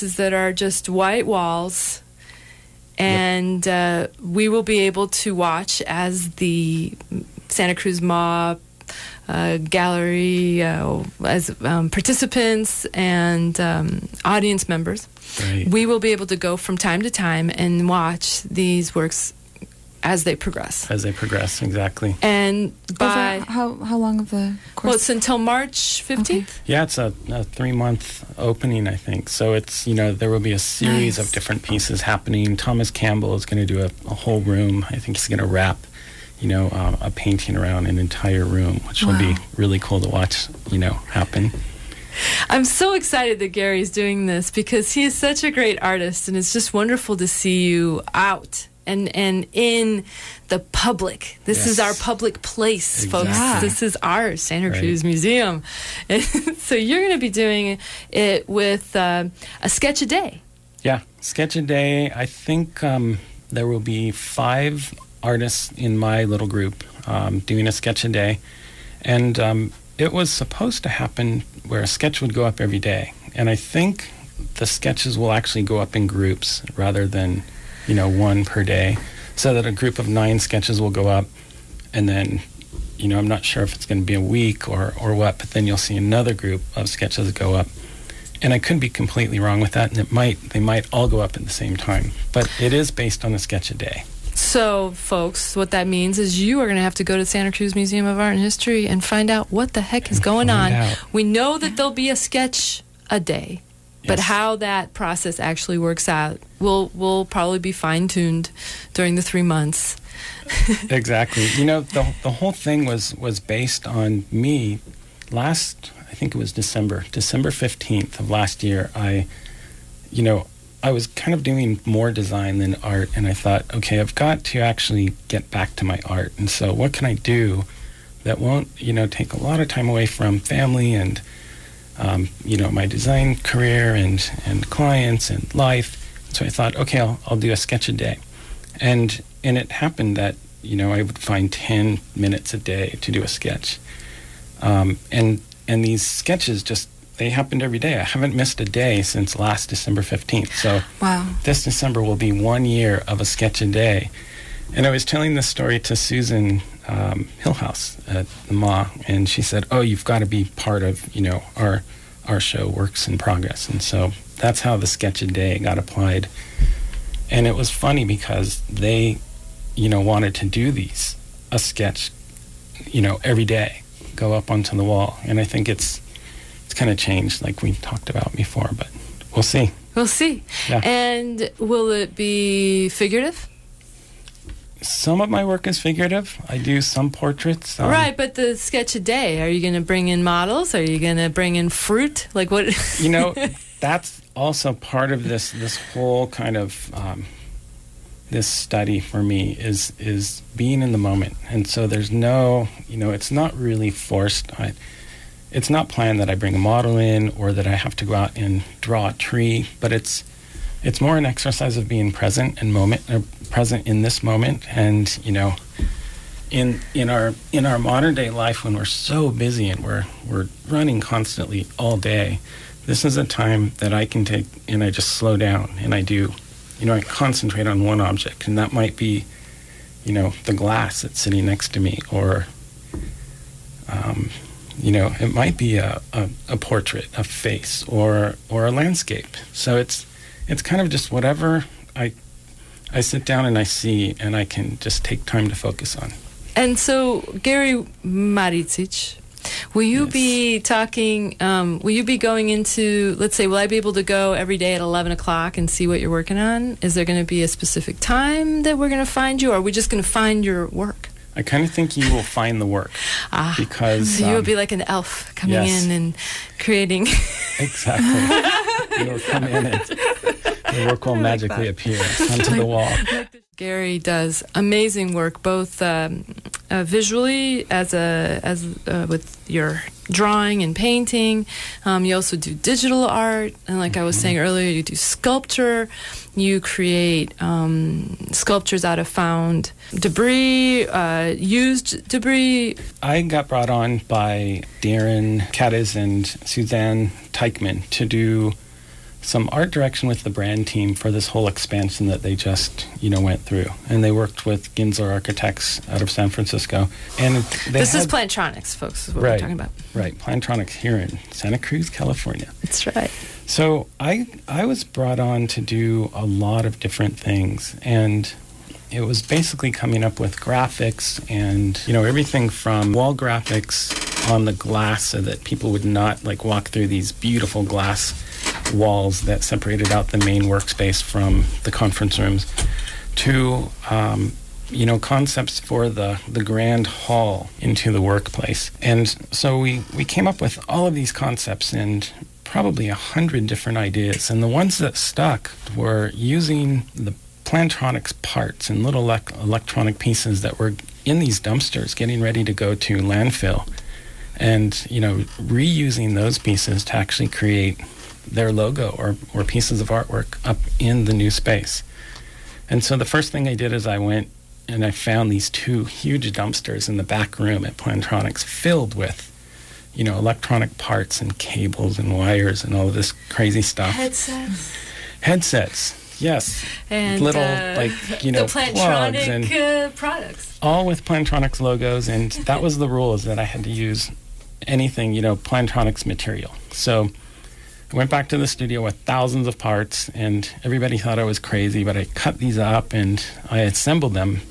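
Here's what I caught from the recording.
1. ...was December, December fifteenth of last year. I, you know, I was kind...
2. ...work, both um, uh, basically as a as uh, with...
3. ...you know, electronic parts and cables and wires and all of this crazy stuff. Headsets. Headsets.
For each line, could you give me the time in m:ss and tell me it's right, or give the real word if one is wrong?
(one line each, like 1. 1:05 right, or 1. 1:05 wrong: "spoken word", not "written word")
1. 1:56 right
2. 4:35 wrong: "visually", not "basically"
3. 6:09 right.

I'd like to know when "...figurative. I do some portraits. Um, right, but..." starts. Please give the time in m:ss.
3:05.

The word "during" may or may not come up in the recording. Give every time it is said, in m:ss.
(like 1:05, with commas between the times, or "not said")
1:48.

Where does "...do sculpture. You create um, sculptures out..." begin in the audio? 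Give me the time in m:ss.
4:44.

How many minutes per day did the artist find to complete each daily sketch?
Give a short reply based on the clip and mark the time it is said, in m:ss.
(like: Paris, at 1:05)
10, at 2:21.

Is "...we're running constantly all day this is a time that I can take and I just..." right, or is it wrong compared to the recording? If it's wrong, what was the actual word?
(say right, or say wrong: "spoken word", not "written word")
right.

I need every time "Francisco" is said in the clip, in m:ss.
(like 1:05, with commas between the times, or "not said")
5:06.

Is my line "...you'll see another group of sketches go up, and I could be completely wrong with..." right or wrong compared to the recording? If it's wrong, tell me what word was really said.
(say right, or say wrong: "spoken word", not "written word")
right.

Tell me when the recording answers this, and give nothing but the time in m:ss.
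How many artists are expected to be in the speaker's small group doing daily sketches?
1:04.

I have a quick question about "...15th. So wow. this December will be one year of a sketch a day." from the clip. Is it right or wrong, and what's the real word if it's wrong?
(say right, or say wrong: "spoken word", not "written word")
right.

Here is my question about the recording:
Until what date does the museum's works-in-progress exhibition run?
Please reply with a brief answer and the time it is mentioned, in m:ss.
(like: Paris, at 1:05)
March 15, at 0:25.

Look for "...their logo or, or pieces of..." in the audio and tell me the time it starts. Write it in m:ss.
5:58.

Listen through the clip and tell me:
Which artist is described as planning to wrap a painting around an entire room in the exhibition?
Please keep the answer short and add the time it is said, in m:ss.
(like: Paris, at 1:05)
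Thomas Campbell, at 0:32.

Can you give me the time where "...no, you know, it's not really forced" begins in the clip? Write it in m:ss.
3:22.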